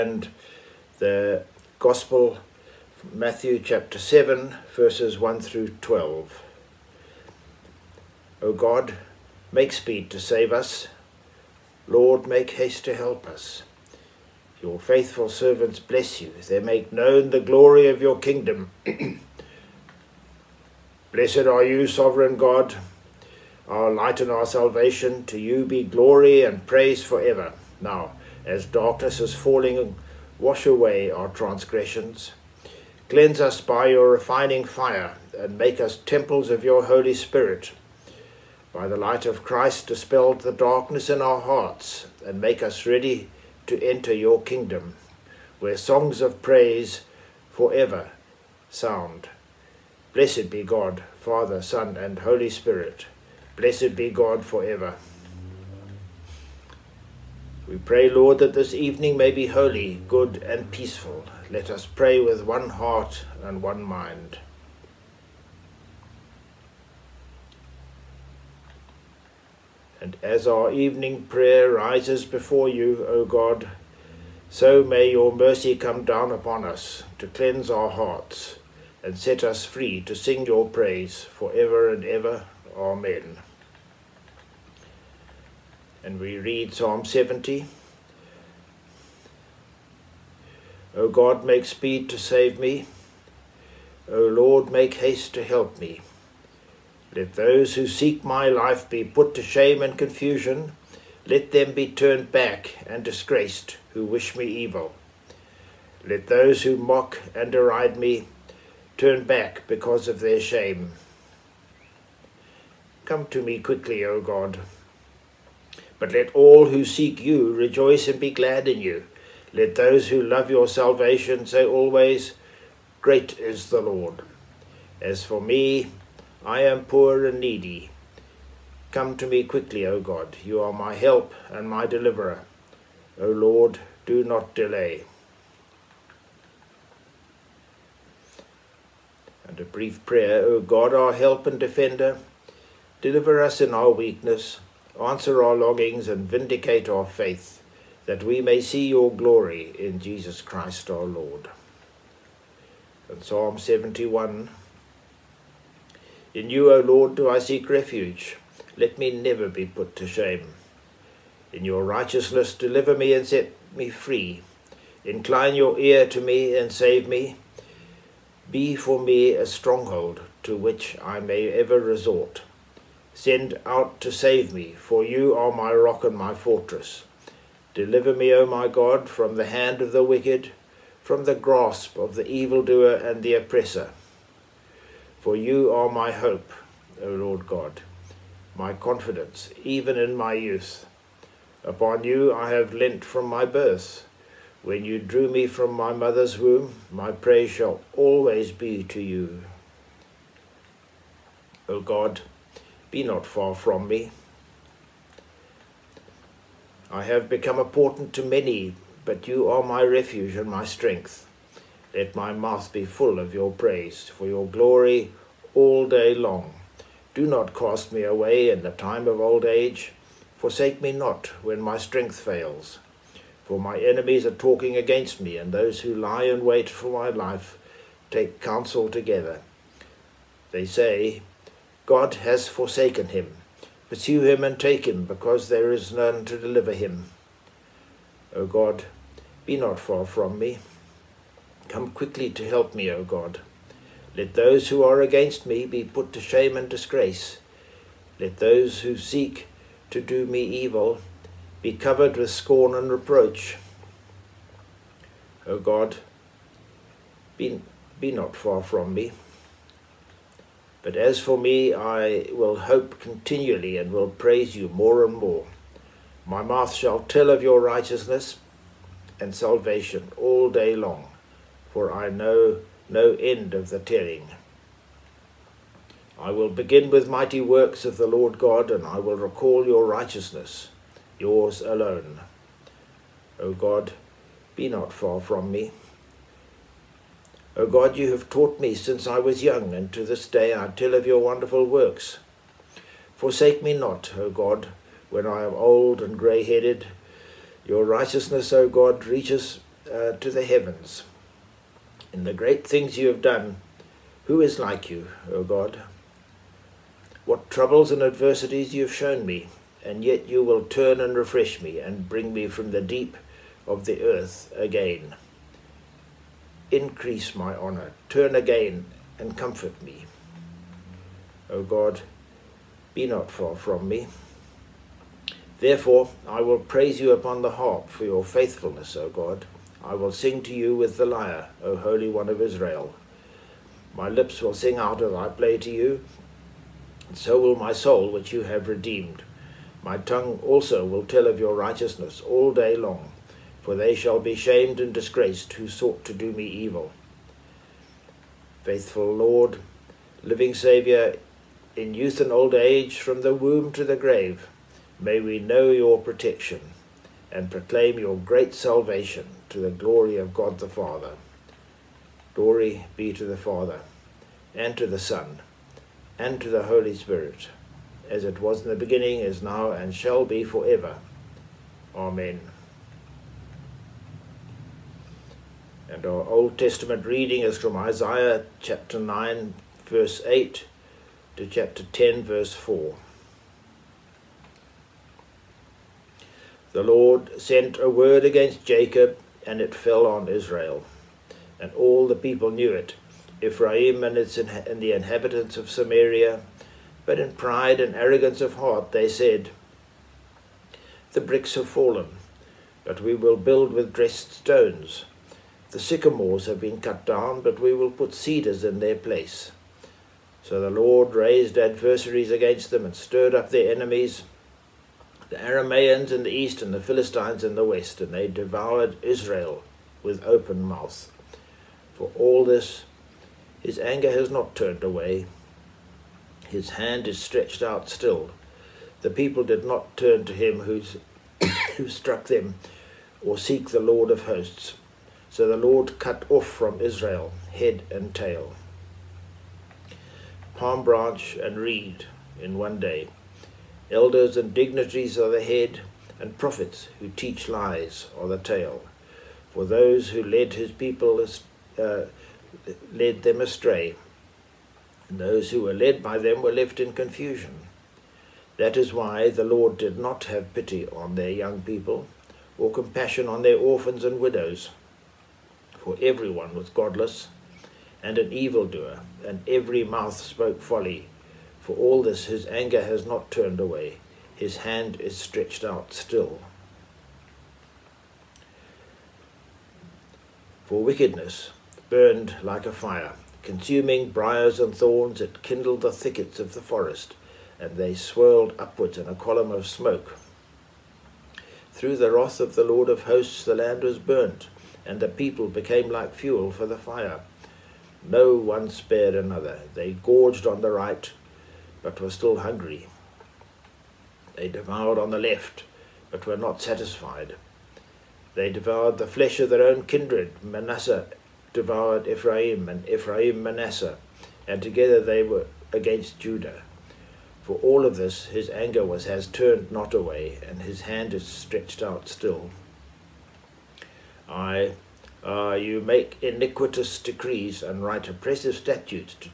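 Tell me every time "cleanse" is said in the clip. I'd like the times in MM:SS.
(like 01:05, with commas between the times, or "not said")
00:33, 01:17.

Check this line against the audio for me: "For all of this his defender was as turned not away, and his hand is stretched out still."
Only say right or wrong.
wrong.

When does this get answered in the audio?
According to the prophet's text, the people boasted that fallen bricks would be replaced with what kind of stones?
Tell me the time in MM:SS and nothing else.
06:43.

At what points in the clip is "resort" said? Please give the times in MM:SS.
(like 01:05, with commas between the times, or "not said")
02:51.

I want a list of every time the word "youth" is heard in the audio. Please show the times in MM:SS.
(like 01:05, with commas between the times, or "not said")
03:10, 05:51.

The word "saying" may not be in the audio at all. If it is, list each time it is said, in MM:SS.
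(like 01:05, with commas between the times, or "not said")
not said.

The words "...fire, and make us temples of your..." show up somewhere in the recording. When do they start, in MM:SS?
00:34.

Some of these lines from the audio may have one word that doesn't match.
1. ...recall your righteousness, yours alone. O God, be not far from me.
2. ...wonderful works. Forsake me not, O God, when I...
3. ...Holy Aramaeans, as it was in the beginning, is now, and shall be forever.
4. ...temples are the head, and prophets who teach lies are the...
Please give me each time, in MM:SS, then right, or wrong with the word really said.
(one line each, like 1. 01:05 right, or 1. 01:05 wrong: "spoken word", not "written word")
1. 04:39 right
2. 04:51 right
3. 06:06 wrong: "Spirit", not "Aramaeans"
4. 07:24 wrong: "dignitaries", not "temples".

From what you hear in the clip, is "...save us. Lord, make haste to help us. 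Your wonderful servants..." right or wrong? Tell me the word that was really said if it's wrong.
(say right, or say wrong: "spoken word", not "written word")
wrong: "faithful", not "wonderful".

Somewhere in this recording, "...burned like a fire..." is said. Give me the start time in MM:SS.
08:01.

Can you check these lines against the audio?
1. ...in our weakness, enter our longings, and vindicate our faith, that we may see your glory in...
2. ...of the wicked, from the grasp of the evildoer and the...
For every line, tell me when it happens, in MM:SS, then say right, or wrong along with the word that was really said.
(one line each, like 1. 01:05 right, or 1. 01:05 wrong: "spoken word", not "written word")
1. 02:23 wrong: "answer", not "enter"
2. 02:59 right.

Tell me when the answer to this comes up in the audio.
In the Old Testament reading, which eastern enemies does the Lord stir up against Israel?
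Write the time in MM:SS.
06:55.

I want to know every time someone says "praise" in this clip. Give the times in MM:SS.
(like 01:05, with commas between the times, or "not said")
00:26, 00:46, 01:20, 03:17, 03:33, 04:24, 05:26.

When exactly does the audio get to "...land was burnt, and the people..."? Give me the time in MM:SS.
08:13.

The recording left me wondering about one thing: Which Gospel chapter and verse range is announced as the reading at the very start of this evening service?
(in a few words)
Matthew 7:1-12.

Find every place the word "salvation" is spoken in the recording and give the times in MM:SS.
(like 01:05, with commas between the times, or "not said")
00:24, 02:00, 04:29, 05:58.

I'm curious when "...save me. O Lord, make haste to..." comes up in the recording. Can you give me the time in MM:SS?
01:32.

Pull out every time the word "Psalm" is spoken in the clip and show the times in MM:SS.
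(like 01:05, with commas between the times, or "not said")
01:26, 02:33.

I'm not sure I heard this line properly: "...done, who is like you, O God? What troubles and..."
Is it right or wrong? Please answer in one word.
right.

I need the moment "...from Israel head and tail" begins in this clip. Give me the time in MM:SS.
07:16.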